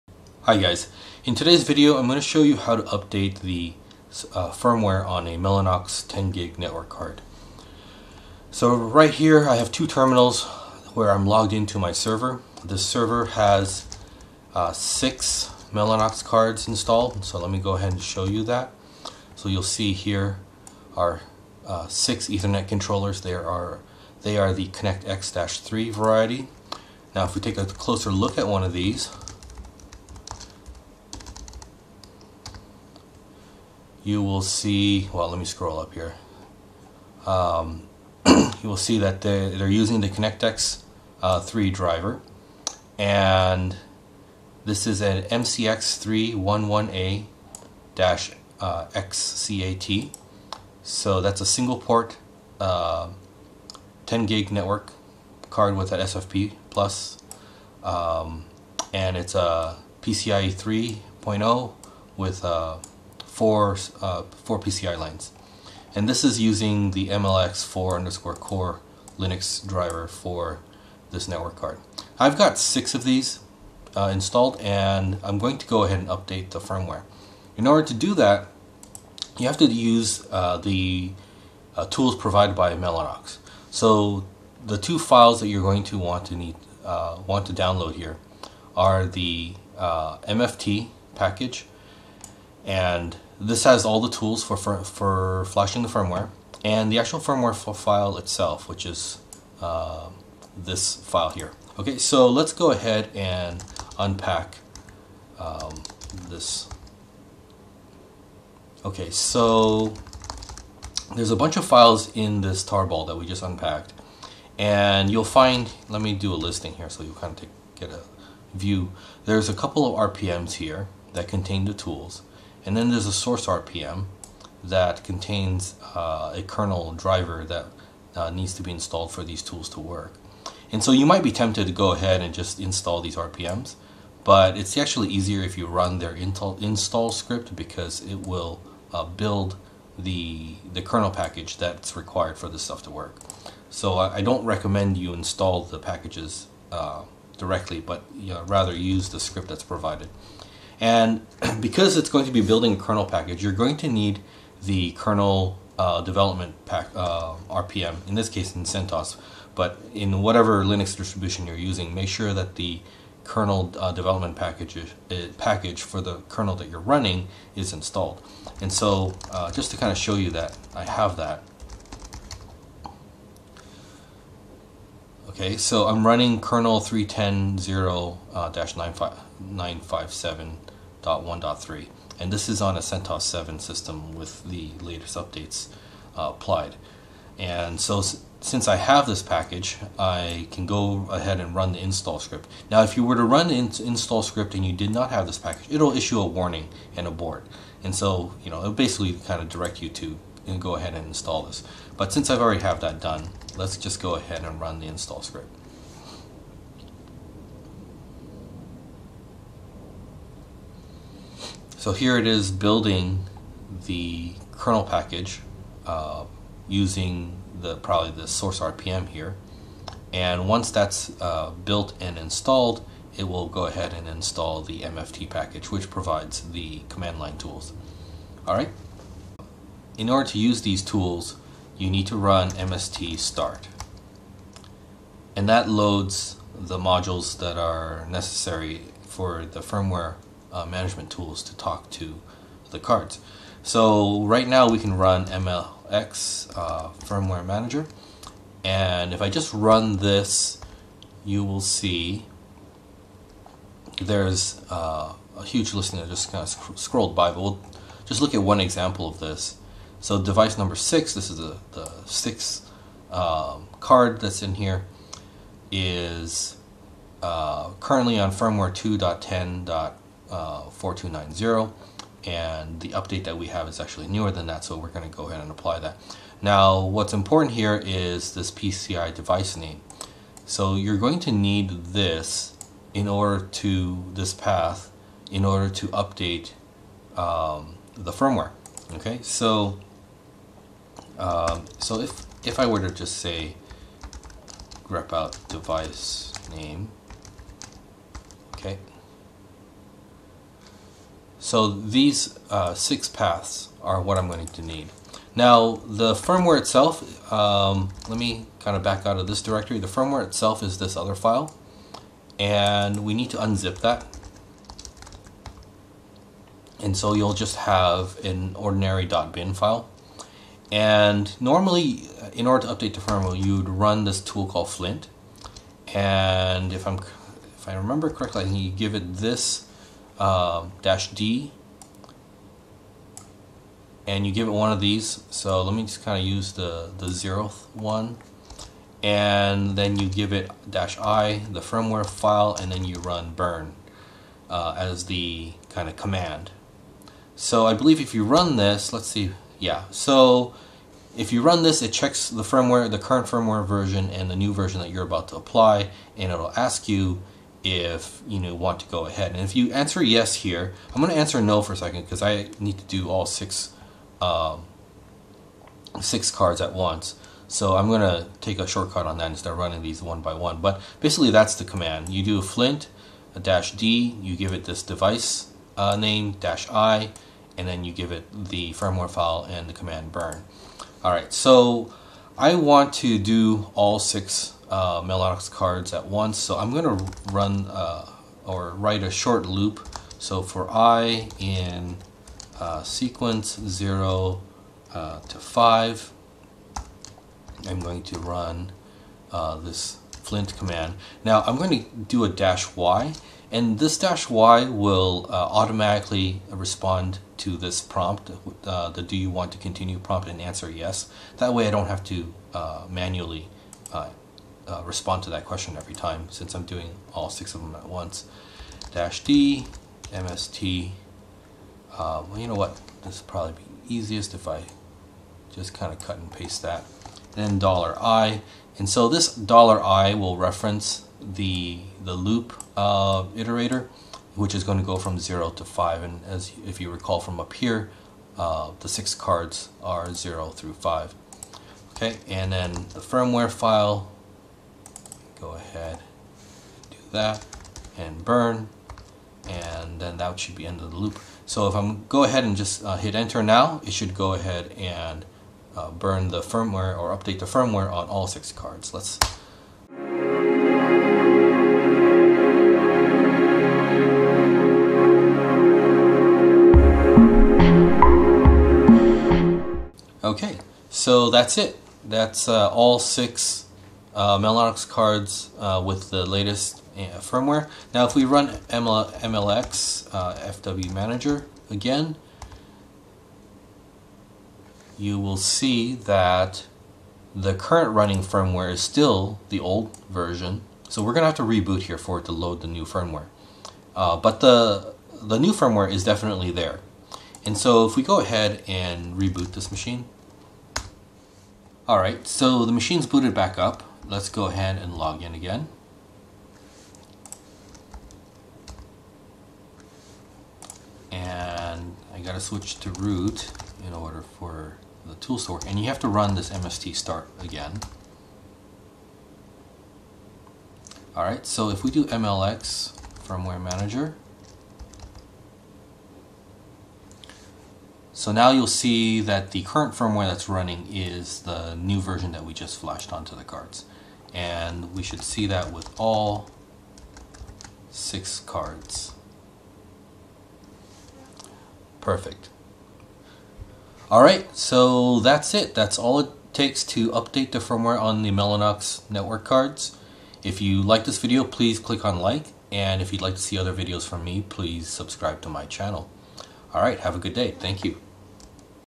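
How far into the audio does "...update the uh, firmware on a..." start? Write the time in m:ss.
0:02.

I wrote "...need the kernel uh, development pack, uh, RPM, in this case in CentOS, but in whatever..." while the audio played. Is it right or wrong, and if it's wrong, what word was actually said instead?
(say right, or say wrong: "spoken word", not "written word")
right.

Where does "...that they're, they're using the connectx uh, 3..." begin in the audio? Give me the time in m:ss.
0:38.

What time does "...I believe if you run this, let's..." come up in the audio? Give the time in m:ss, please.
5:47.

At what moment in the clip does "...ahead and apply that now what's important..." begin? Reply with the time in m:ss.
4:35.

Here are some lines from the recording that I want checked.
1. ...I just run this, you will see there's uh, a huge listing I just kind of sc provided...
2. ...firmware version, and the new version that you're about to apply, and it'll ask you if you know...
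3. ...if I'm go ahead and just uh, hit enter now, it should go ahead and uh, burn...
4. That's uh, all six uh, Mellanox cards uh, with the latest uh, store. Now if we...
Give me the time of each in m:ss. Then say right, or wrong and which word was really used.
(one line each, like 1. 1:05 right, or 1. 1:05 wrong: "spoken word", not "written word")
1. 4:09 wrong: "scrolled", not "provided"
2. 5:53 right
3. 7:31 right
4. 7:52 wrong: "firmware", not "store".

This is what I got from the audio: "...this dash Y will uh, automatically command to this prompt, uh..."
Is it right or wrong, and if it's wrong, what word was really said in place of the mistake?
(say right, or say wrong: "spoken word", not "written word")
wrong: "respond", not "command".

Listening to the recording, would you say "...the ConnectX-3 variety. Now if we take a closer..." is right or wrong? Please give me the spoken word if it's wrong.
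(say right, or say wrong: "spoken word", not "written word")
right.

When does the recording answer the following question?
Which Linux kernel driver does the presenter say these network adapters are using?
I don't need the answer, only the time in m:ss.
1:07.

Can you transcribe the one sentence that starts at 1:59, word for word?
There's a couple of RPMs here that contain the tools.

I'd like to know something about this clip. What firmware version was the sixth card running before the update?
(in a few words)
2.10.4290.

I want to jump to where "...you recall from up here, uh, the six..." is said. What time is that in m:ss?
7:16.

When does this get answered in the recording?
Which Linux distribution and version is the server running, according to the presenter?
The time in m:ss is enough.
3:02.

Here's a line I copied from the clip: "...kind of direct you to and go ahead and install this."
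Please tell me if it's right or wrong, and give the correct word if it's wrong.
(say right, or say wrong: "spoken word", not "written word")
right.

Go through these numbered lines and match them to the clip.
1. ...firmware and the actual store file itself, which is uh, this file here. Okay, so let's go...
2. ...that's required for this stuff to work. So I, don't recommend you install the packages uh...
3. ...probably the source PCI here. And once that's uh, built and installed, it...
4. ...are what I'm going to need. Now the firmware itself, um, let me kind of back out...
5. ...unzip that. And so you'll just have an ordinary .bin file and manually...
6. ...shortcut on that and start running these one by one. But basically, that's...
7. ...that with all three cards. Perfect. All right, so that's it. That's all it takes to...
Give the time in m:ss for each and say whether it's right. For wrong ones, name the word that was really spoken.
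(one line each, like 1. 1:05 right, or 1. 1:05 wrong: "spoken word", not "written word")
1. 1:35 wrong: "firmware", not "store"
2. 2:21 right
3. 3:37 wrong: "RPM", not "PCI"
4. 5:03 right
5. 5:13 wrong: "normally", not "manually"
6. 6:08 right
7. 8:55 wrong: "six", not "three".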